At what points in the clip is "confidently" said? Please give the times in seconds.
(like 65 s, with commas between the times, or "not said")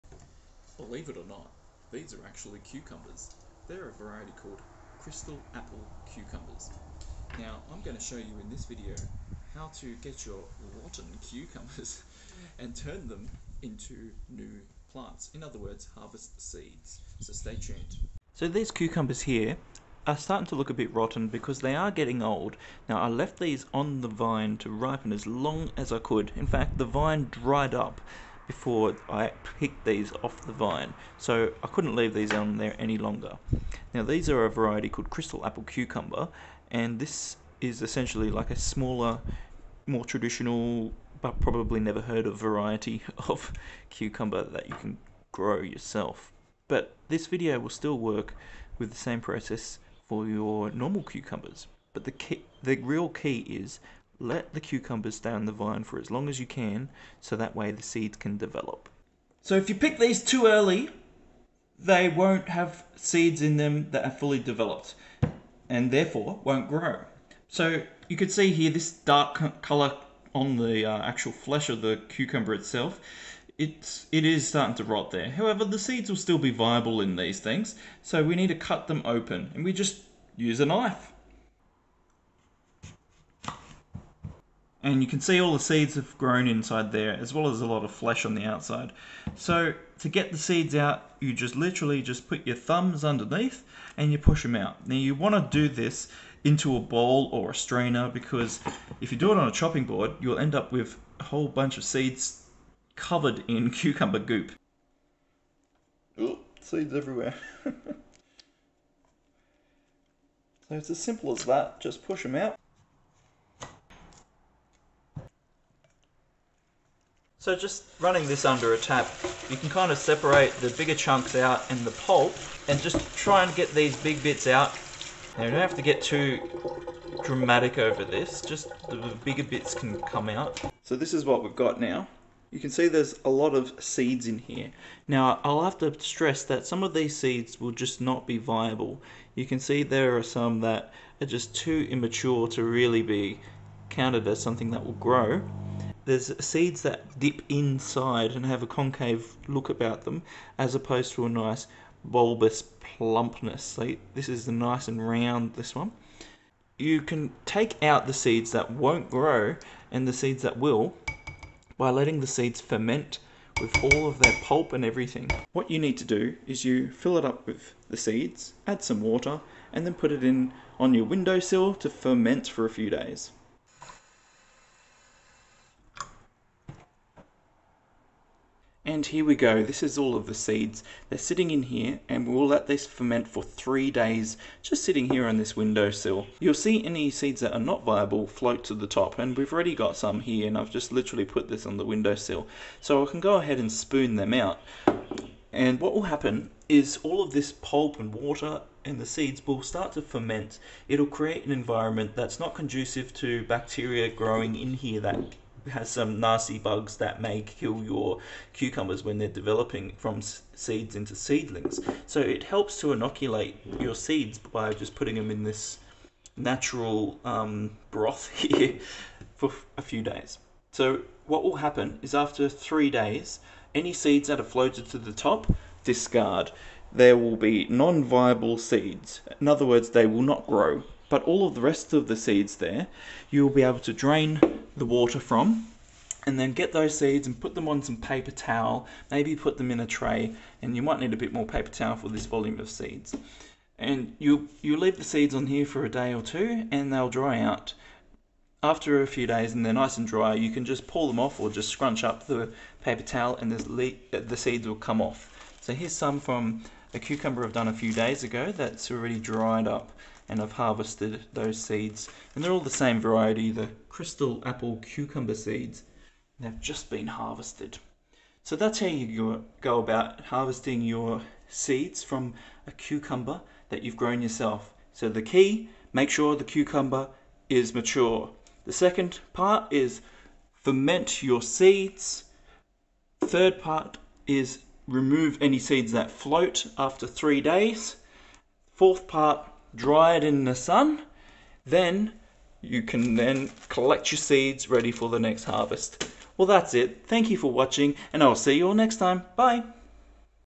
not said.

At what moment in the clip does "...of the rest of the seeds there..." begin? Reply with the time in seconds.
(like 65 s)
231 s.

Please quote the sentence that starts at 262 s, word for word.
And they're all the same variety, the crystal apple cucumber seeds.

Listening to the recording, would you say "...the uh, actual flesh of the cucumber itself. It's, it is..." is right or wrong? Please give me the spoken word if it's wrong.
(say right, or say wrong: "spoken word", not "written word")
right.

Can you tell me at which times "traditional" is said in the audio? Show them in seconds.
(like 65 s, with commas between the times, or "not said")
40 s.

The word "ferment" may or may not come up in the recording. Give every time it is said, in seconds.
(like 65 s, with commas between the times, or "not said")
162 s, 171 s, 182 s, 200 s, 280 s.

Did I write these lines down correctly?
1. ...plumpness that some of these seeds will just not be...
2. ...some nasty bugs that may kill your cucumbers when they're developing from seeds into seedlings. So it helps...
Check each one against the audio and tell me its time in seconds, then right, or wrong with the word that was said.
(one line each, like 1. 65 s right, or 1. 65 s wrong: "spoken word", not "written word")
1. 135 s wrong: "stress", not "plumpness"
2. 205 s right.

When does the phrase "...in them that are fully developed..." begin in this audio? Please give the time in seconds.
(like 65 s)
63 s.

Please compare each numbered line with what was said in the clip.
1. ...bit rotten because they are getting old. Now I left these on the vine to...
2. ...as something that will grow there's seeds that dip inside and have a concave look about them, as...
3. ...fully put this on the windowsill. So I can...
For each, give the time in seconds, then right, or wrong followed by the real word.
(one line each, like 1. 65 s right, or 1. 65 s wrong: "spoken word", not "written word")
1. 20 s right
2. 144 s right
3. 190 s wrong: "literally", not "fully".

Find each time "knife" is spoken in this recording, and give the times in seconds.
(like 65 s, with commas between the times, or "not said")
80 s.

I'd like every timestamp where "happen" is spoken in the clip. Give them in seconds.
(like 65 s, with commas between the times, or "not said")
196 s, 221 s.